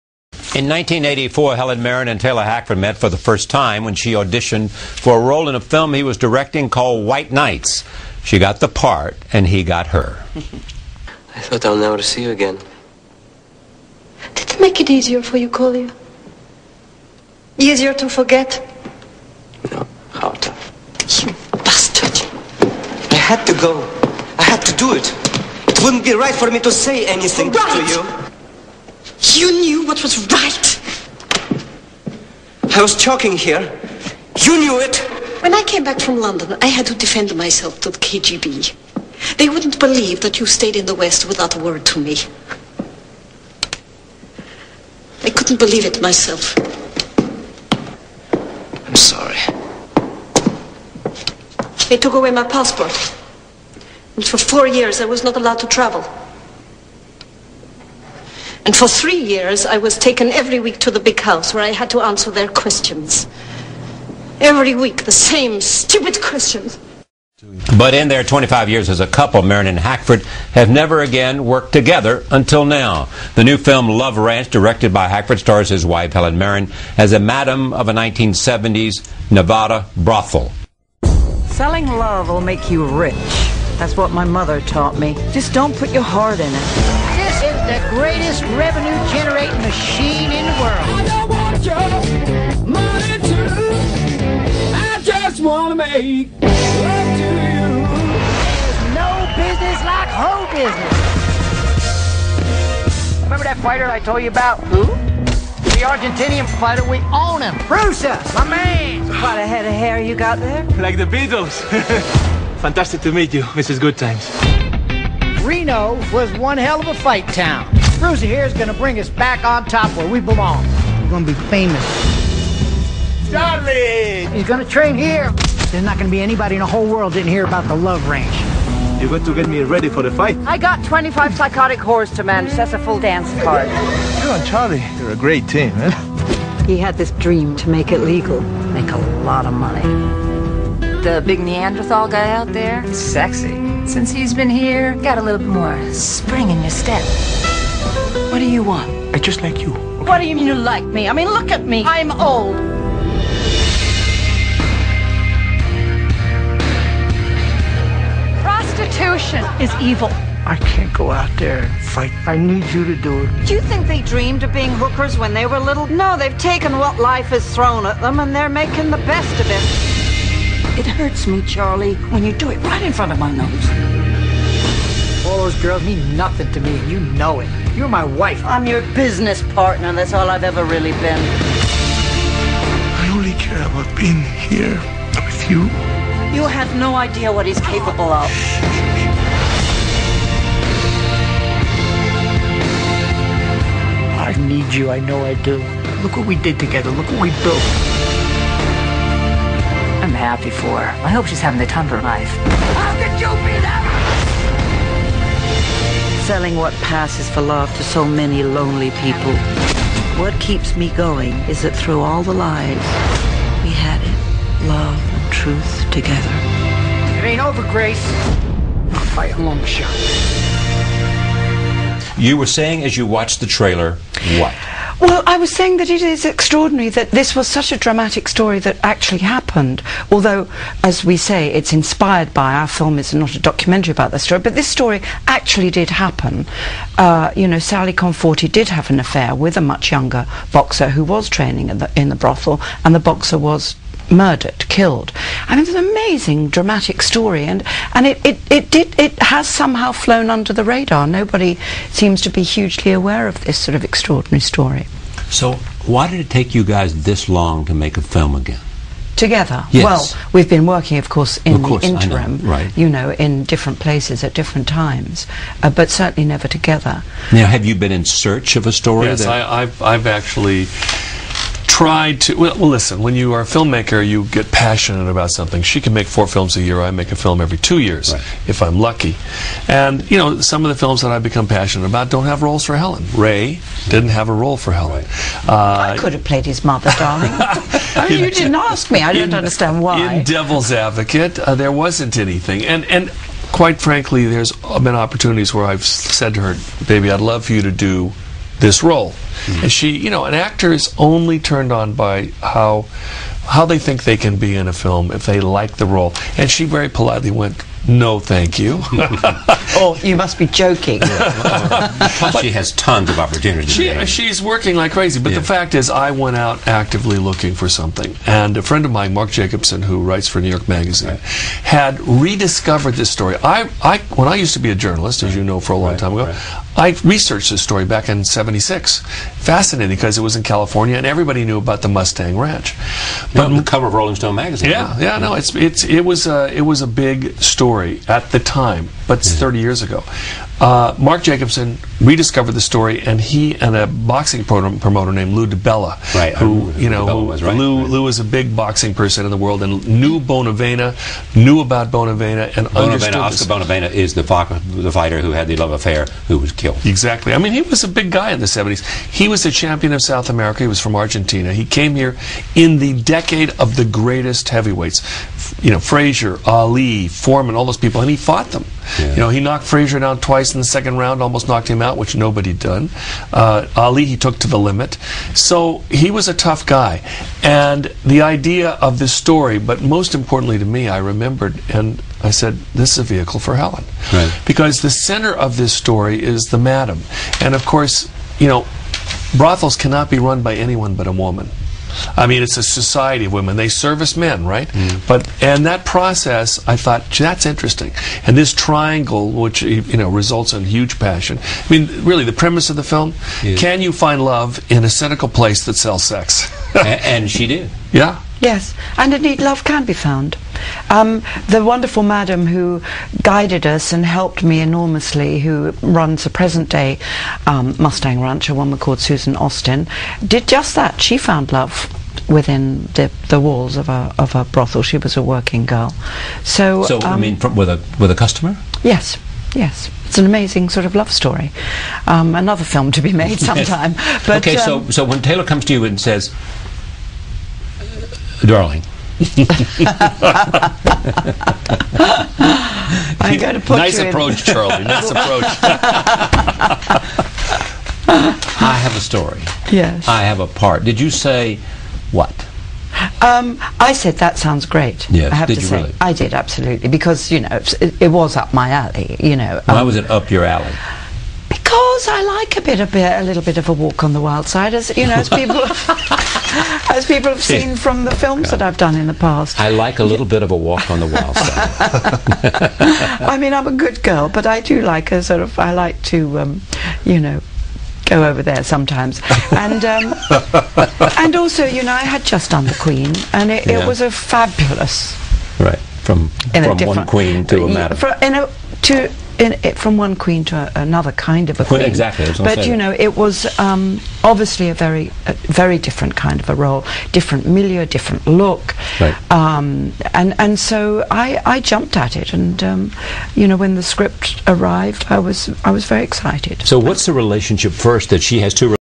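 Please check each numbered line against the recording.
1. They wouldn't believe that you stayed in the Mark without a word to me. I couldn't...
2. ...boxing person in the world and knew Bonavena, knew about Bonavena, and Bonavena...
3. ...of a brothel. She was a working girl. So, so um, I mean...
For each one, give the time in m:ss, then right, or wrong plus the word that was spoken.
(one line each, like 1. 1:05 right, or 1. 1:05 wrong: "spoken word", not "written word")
1. 0:39 wrong: "West", not "Mark"
2. 5:48 right
3. 7:04 right.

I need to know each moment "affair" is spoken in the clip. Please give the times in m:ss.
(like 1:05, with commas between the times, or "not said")
3:58, 5:55.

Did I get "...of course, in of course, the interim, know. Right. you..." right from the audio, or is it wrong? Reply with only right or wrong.
right.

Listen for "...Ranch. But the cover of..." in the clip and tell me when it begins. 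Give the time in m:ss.
5:32.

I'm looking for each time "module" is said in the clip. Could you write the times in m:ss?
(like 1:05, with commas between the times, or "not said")
not said.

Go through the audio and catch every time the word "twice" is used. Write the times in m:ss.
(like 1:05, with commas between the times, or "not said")
6:10.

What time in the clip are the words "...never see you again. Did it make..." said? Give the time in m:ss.
0:11.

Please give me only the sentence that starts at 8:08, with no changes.
in a, to in, it, from one queen to a, another kind of a queen.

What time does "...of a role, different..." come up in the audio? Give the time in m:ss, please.
8:16.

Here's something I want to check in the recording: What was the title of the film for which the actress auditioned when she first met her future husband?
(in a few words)
White Nights.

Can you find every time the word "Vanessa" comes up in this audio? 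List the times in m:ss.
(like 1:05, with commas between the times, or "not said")
not said.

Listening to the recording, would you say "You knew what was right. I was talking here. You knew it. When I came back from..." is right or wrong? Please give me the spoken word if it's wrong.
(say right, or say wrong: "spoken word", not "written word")
right.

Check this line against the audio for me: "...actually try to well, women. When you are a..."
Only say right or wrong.
wrong.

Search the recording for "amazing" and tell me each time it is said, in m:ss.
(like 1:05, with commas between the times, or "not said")
4:05, 7:10.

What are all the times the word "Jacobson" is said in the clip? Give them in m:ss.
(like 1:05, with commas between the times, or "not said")
5:19, 5:41.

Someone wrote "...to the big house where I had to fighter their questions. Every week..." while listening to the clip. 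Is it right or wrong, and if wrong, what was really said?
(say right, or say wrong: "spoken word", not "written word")
wrong: "answer", not "fighter".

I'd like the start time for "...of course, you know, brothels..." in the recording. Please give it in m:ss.
6:27.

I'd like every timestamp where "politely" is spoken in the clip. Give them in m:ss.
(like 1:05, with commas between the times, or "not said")
5:06.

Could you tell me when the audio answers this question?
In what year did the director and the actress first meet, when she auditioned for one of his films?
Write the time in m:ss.
0:00.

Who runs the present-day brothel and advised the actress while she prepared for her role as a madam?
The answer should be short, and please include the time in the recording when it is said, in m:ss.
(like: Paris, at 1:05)
Susan Austin, at 6:58.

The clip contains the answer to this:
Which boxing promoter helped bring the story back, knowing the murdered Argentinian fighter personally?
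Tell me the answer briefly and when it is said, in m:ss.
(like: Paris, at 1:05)
Lou DiBella, at 5:45.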